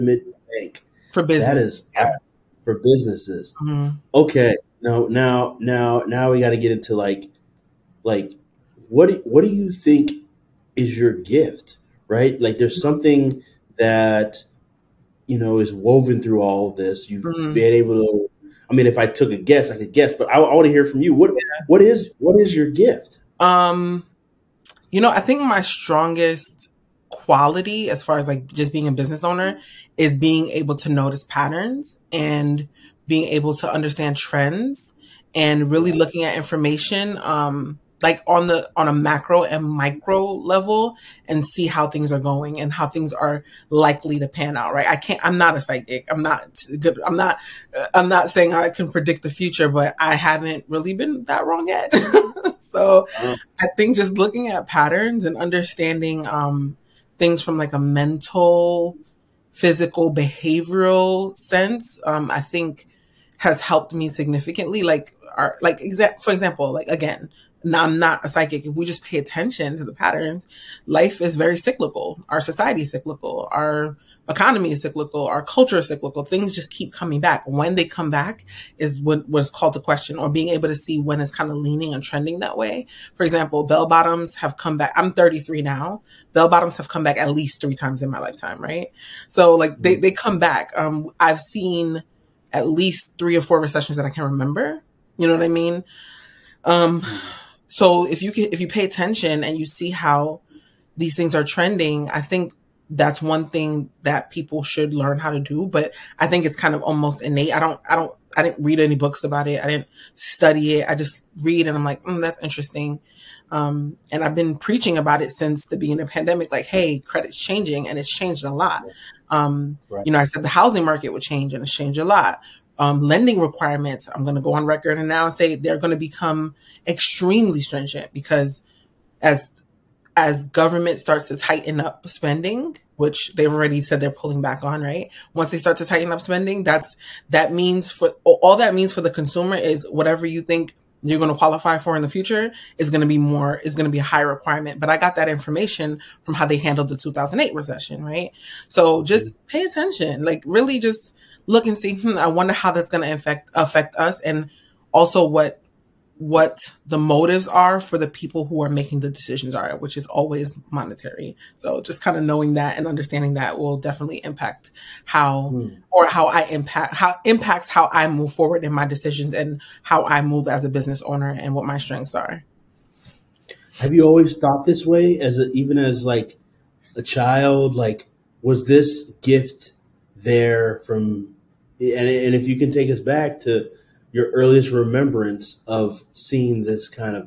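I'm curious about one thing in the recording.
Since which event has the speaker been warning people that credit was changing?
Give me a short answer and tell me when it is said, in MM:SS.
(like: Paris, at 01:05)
The pandemic, at 01:56.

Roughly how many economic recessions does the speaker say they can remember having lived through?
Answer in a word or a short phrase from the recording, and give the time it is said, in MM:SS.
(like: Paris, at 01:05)
3 or 4, at 01:33.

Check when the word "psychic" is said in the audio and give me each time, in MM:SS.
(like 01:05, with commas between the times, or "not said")
00:45, 01:08.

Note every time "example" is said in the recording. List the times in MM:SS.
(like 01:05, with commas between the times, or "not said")
01:06, 01:23.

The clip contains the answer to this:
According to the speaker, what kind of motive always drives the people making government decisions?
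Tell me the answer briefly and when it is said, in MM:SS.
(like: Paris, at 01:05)
Monetary, at 02:40.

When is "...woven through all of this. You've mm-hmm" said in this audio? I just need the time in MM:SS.
00:15.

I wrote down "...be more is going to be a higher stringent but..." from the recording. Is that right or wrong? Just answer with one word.
wrong.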